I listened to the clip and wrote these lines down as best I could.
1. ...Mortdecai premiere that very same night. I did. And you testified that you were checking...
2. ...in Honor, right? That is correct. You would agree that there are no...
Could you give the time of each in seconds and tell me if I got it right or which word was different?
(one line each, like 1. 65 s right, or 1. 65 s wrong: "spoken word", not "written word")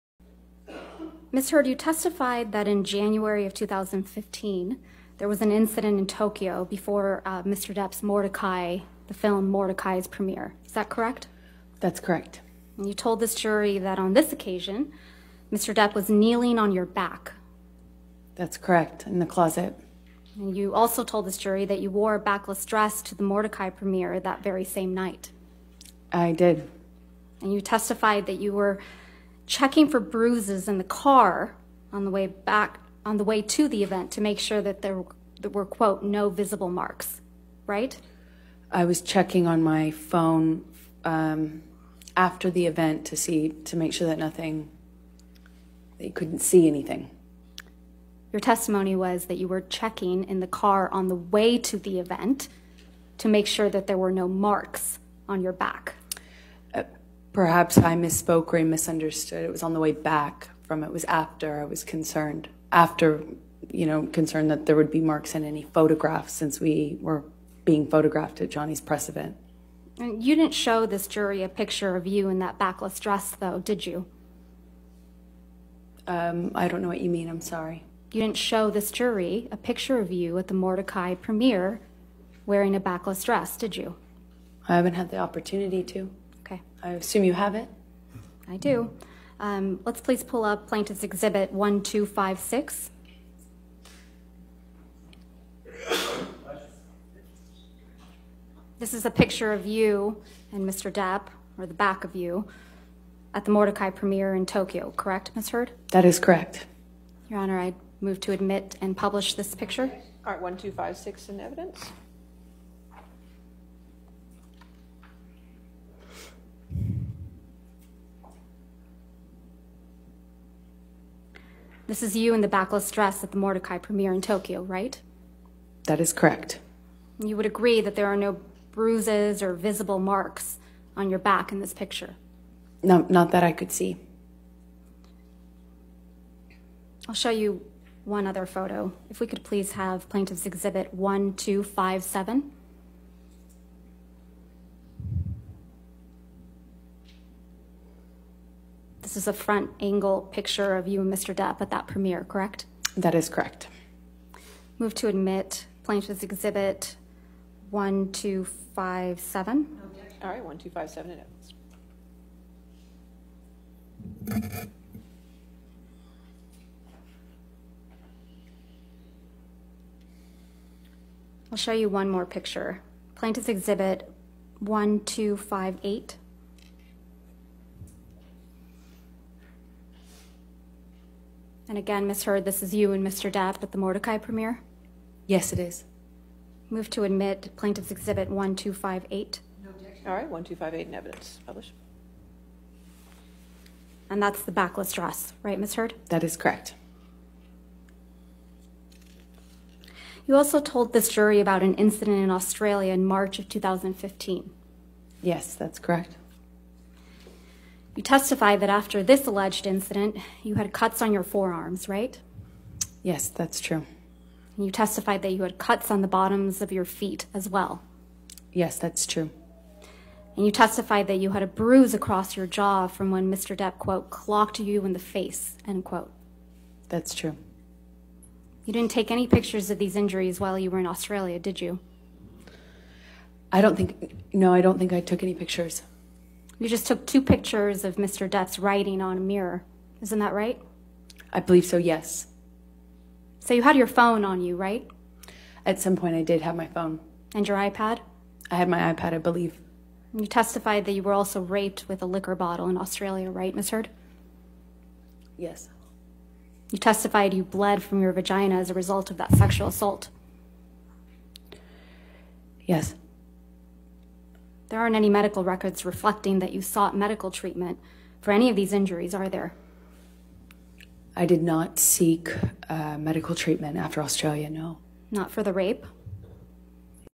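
1. 23 s right
2. 124 s wrong: "Tokyo", not "Honor".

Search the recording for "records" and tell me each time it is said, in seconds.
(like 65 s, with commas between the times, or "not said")
265 s.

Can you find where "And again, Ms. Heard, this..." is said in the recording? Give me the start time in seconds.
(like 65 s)
181 s.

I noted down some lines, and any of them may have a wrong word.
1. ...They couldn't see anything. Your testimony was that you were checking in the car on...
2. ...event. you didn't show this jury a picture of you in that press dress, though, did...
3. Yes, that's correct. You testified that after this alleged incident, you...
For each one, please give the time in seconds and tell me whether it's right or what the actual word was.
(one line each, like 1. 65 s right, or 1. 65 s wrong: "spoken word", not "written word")
1. 45 s right
2. 69 s wrong: "backless", not "press"
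3. 205 s right.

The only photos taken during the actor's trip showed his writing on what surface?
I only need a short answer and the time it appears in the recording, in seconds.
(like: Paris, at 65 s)
A mirror, at 239 s.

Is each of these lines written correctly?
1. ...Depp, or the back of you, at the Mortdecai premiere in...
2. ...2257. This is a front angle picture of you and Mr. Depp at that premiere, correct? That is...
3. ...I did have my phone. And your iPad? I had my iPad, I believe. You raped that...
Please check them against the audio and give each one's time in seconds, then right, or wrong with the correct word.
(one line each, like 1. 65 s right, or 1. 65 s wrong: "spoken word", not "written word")
1. 100 s right
2. 140 s wrong: "1257", not "2257"
3. 246 s wrong: "testified", not "raped".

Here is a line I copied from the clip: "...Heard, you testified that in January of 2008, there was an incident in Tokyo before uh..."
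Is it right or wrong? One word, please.
wrong.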